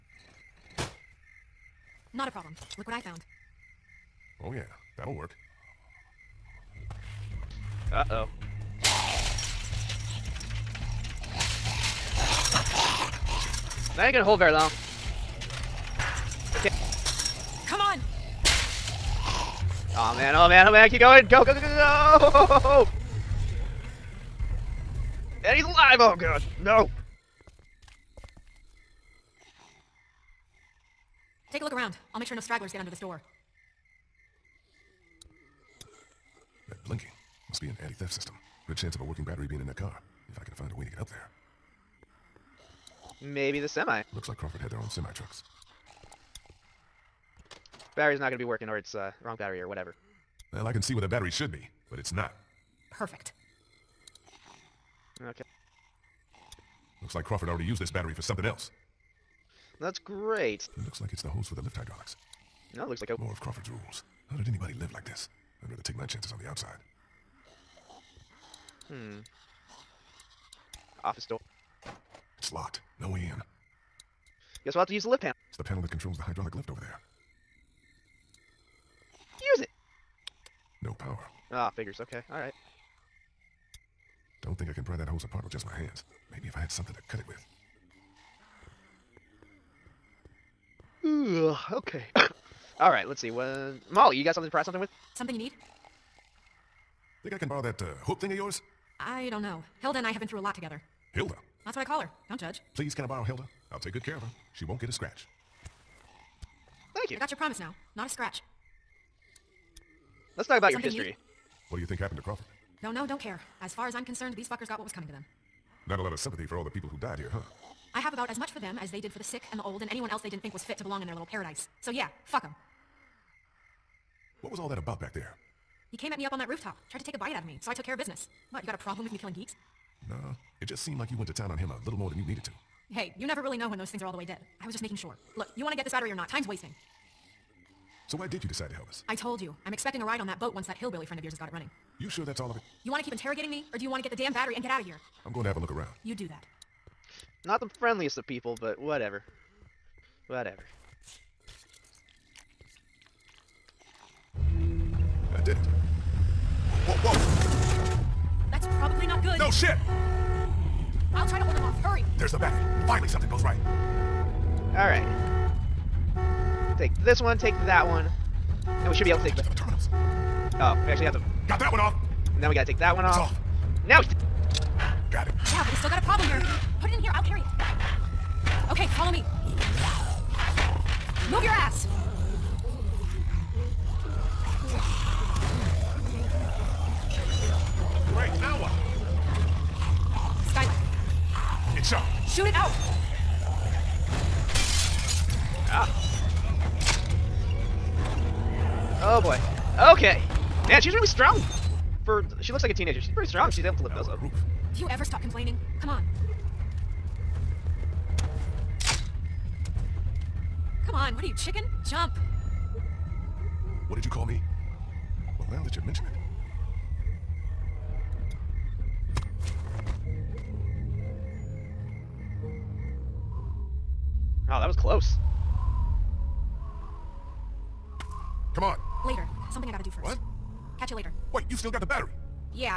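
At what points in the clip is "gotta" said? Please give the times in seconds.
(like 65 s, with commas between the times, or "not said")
172 s, 229 s.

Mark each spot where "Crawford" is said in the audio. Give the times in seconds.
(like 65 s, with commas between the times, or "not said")
44 s, 57 s, 63 s, 112 s.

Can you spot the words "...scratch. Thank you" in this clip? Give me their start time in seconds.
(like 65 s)
104 s.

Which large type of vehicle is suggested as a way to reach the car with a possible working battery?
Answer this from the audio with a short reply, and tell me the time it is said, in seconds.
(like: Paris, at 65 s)
Semi, at 43 s.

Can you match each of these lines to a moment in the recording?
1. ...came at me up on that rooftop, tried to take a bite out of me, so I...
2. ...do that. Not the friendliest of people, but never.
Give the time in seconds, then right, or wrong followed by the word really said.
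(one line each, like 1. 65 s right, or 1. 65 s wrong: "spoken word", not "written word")
1. 125 s right
2. 146 s wrong: "whatever", not "never".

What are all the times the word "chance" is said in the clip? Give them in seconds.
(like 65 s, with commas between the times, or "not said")
38 s, 66 s.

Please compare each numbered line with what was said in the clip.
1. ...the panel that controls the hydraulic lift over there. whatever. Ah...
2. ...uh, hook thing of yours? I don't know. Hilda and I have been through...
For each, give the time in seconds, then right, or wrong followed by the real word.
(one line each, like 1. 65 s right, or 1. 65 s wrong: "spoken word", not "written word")
1. 75 s wrong: "power", not "whatever"
2. 97 s right.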